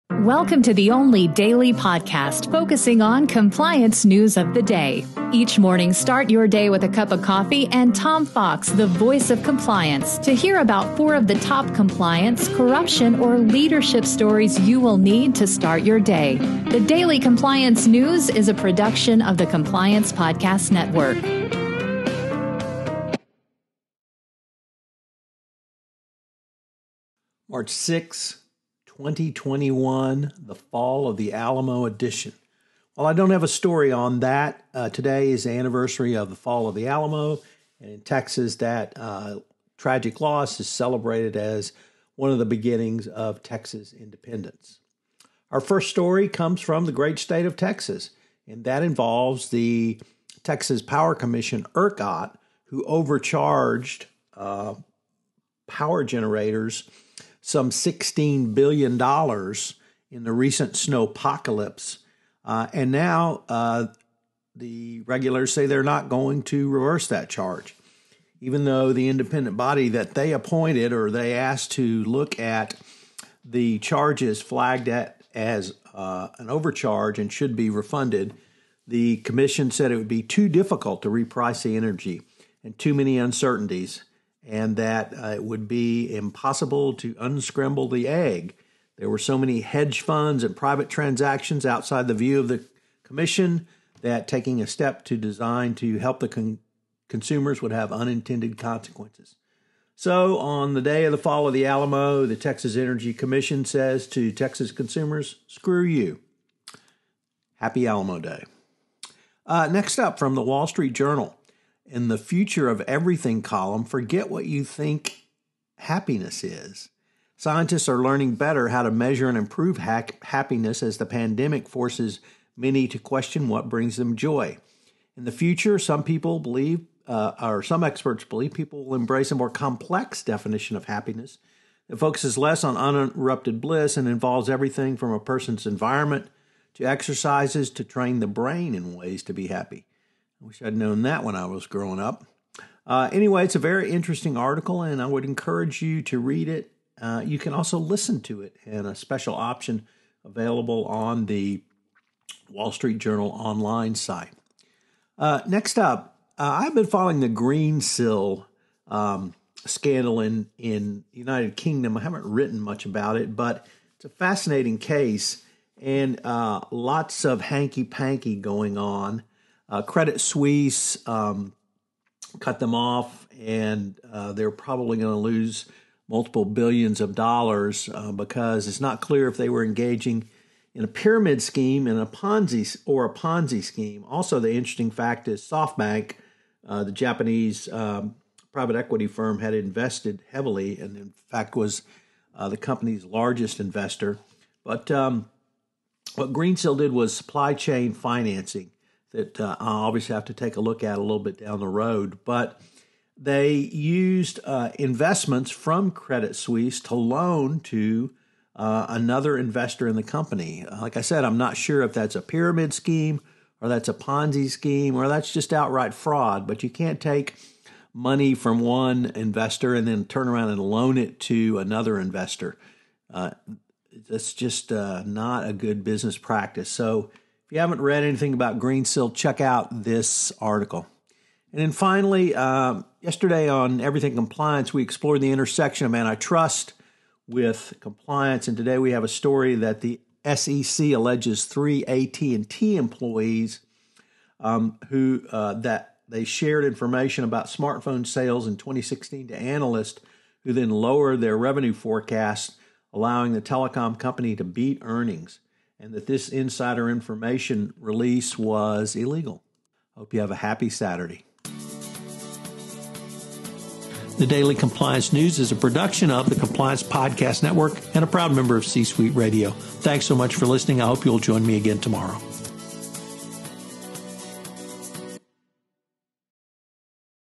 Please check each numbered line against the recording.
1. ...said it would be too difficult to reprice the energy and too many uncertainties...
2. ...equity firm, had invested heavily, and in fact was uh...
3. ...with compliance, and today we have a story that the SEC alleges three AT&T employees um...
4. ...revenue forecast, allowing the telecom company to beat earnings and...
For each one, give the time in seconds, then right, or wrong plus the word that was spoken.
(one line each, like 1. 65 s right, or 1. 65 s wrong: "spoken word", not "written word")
1. 79 s right
2. 188 s right
3. 237 s right
4. 251 s right.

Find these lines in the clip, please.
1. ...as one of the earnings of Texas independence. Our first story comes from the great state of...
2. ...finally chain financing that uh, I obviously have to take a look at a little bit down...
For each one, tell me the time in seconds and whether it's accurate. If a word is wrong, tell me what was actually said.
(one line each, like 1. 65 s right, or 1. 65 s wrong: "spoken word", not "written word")
1. 41 s wrong: "beginnings", not "earnings"
2. 197 s wrong: "supply", not "finally".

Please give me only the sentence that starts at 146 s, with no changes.
Uh, you can also listen to it and a special option available on the Wall Street Journal online site.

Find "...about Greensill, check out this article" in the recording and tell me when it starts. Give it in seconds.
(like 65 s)
228 s.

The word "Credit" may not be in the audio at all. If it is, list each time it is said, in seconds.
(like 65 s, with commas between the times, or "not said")
169 s, 205 s.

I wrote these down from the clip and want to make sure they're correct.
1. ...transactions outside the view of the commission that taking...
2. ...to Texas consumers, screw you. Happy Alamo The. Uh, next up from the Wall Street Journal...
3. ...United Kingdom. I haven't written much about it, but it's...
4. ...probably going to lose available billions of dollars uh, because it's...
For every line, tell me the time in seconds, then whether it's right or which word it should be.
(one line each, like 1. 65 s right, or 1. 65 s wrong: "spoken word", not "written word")
1. 90 s right
2. 104 s wrong: "Day", not "The"
3. 161 s right
4. 174 s wrong: "multiple", not "available".